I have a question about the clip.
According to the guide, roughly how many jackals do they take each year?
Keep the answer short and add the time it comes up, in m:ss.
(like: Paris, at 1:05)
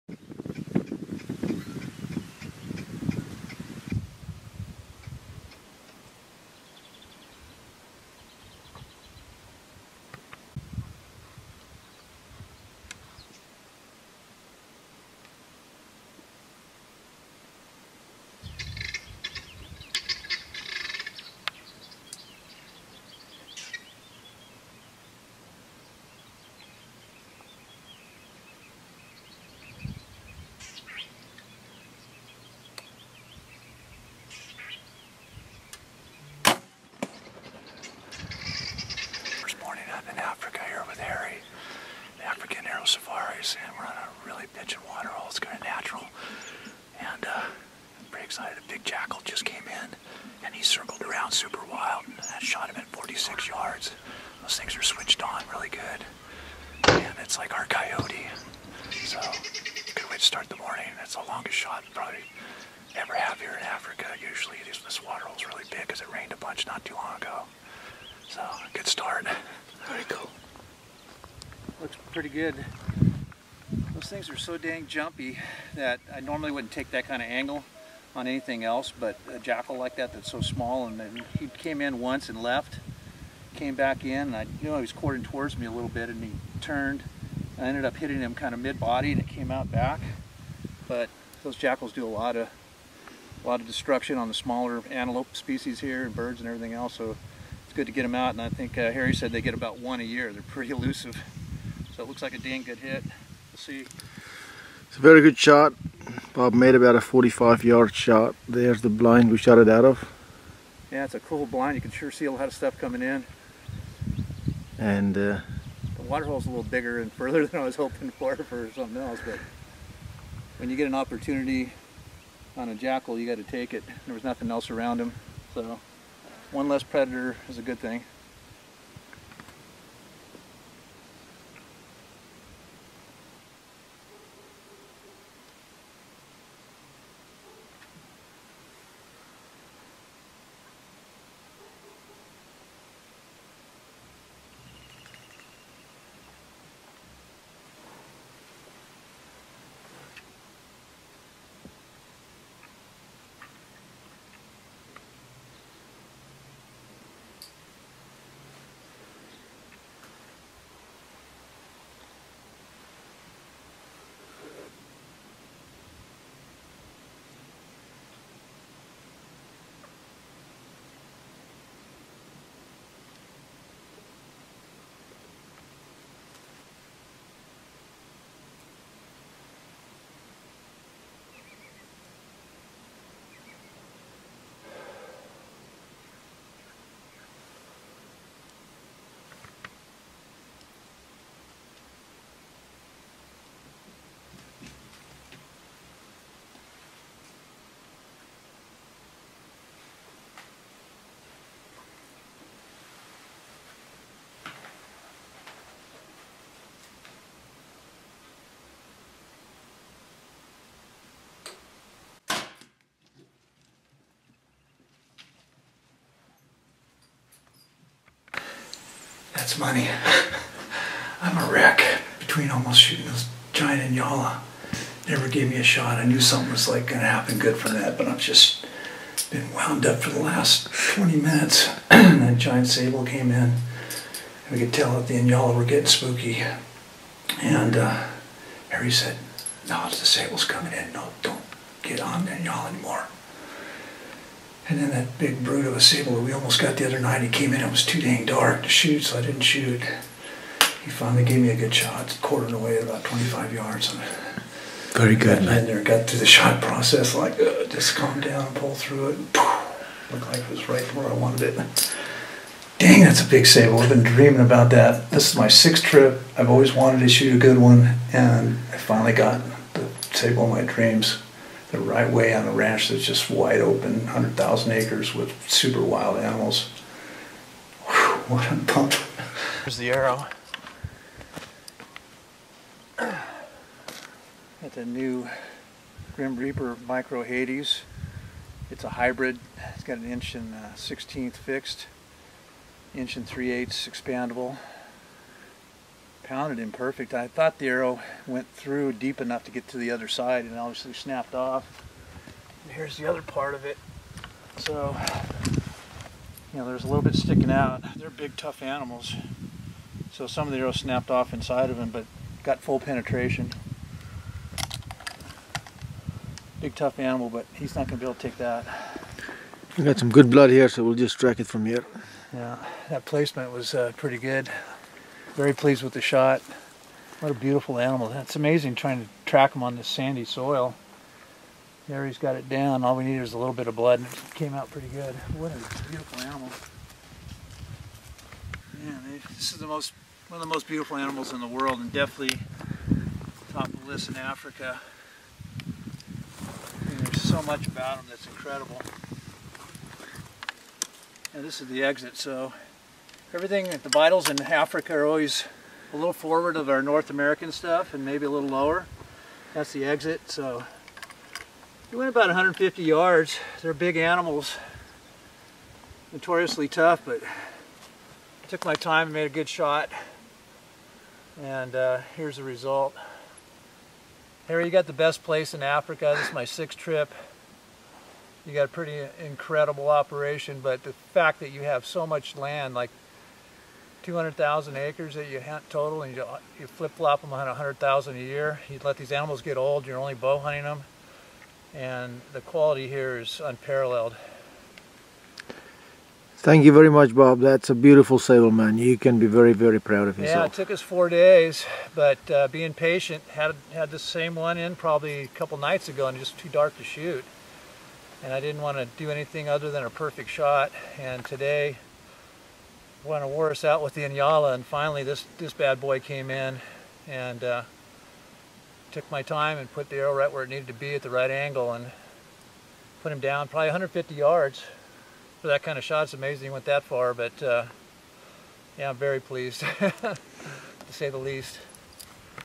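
1 a year, at 1:39.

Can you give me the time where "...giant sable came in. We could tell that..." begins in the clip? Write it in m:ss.
3:52.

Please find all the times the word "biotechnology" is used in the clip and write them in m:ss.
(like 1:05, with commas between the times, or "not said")
not said.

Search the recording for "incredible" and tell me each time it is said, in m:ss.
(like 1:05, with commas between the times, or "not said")
5:48, 6:19.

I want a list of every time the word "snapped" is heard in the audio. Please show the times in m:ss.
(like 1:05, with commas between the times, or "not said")
5:00, 5:10.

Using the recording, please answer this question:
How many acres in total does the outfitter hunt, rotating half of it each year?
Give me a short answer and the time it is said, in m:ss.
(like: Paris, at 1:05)
200,000 acres, at 6:24.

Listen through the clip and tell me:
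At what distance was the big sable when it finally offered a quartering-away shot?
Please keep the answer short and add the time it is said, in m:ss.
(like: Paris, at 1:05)
25 yards, at 4:13.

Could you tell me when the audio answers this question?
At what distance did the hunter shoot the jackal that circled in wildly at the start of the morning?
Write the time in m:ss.
0:52.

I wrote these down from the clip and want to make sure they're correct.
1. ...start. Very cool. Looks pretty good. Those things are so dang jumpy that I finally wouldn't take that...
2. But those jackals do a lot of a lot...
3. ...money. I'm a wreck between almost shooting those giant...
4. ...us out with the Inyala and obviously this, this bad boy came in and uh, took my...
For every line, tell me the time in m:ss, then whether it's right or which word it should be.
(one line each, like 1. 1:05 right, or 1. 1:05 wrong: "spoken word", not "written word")
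1. 1:08 wrong: "normally", not "finally"
2. 1:30 right
3. 3:39 right
4. 6:53 wrong: "finally", not "obviously".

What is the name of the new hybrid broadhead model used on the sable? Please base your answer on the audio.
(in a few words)
Micro Hades.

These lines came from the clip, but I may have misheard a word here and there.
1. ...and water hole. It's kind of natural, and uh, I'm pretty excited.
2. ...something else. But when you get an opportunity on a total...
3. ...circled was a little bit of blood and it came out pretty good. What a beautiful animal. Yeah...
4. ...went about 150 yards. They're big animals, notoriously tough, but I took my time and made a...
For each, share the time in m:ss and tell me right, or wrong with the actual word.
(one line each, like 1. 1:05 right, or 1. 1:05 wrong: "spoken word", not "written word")
1. 0:44 right
2. 1:58 wrong: "jackal", not "total"
3. 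5:33 wrong: "needed", not "circled"
4. 6:01 right.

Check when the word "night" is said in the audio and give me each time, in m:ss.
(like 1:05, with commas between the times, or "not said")
4:06, 6:45.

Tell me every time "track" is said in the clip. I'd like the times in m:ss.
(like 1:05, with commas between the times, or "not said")
5:21, 5:29.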